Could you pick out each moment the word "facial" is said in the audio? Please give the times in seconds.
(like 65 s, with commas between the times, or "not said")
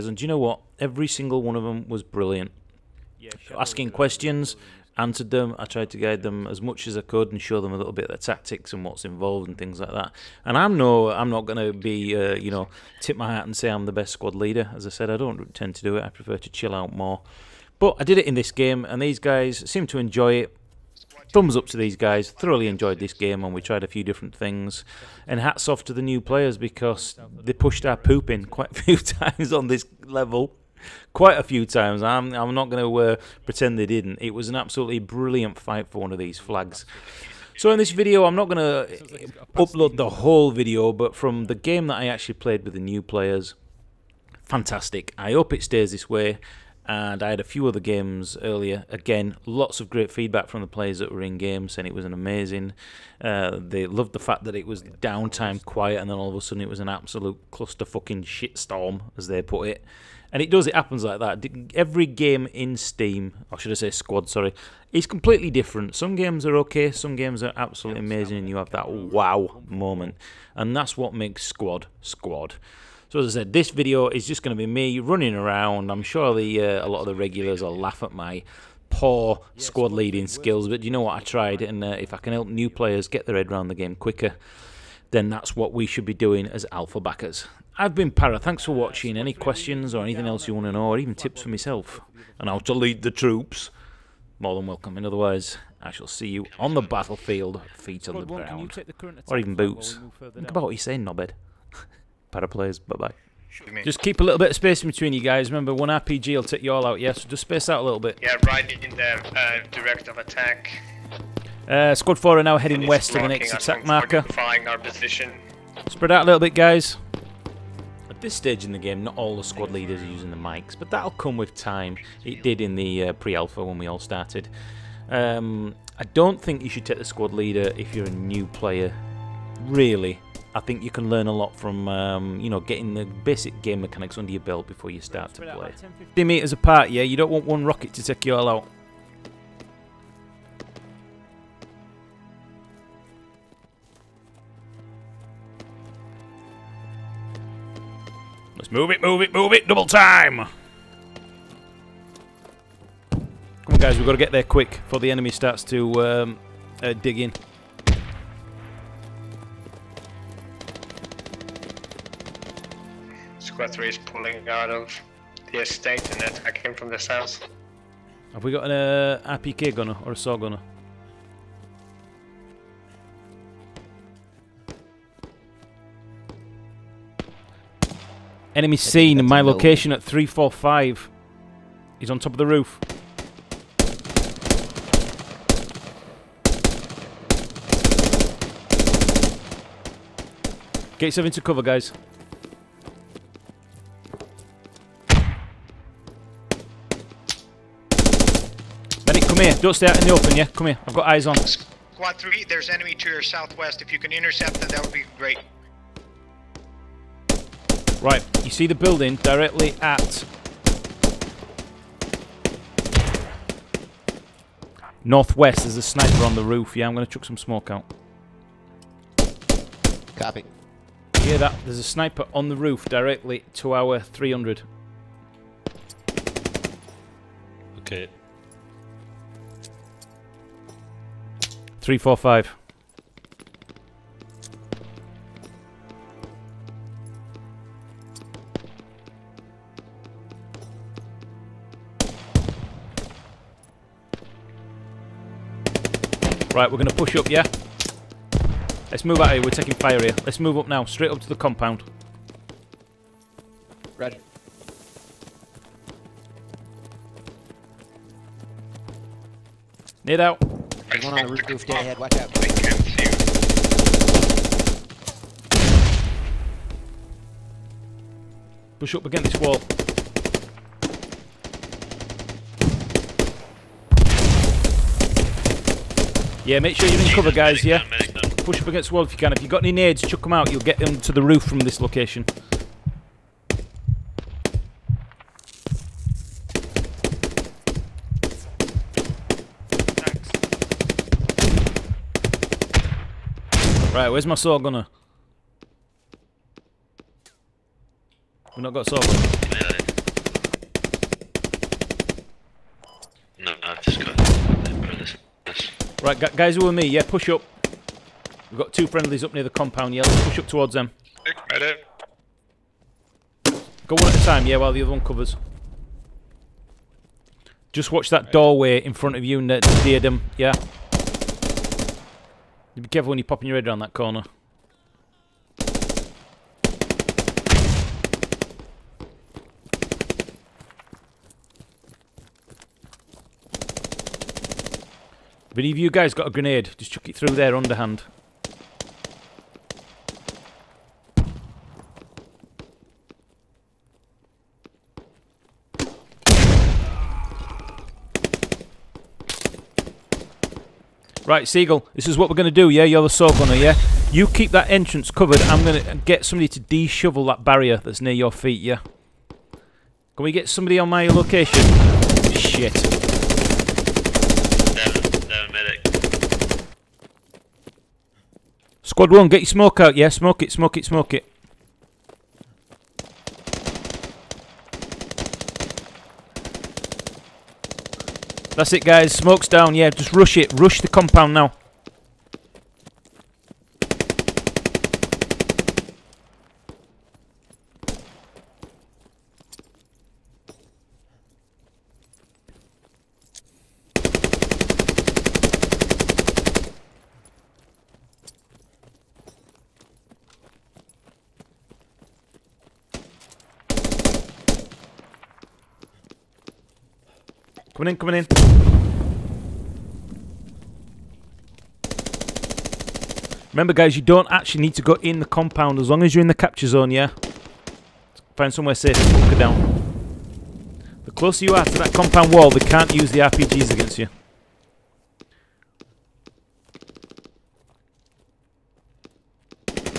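not said.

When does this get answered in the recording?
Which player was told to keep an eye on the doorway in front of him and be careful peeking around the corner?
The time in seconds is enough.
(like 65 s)
319 s.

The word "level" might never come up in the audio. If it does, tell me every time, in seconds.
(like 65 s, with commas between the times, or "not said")
30 s.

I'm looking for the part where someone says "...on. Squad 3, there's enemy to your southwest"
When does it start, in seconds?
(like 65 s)
201 s.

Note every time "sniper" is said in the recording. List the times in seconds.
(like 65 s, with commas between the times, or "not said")
215 s, 221 s.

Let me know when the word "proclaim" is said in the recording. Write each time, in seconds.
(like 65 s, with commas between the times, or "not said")
not said.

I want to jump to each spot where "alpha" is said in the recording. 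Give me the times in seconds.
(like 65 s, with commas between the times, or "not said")
86 s, 123 s.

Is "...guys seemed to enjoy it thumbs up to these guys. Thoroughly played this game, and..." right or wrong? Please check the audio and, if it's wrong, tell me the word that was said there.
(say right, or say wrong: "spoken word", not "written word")
wrong: "enjoyed", not "played".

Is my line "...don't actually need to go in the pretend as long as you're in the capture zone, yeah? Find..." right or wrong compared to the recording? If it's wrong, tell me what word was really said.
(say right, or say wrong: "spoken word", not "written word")
wrong: "compound", not "pretend".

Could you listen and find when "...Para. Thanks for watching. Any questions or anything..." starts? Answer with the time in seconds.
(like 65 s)
88 s.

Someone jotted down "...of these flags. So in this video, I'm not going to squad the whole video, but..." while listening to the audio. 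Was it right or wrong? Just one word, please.
wrong.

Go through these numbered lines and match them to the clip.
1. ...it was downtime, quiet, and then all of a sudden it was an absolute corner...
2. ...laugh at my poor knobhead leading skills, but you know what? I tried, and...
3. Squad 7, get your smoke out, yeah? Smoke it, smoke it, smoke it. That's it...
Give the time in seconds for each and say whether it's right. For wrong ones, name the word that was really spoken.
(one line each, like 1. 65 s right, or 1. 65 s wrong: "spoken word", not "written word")
1. 54 s wrong: "cluster", not "corner"
2. 77 s wrong: "squad", not "knobhead"
3. 368 s wrong: "1", not "7".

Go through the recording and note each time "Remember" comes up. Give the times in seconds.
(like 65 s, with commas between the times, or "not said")
105 s, 413 s.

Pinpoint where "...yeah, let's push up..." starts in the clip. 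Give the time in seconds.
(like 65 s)
309 s.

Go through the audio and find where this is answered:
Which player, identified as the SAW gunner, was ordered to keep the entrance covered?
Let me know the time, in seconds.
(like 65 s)
351 s.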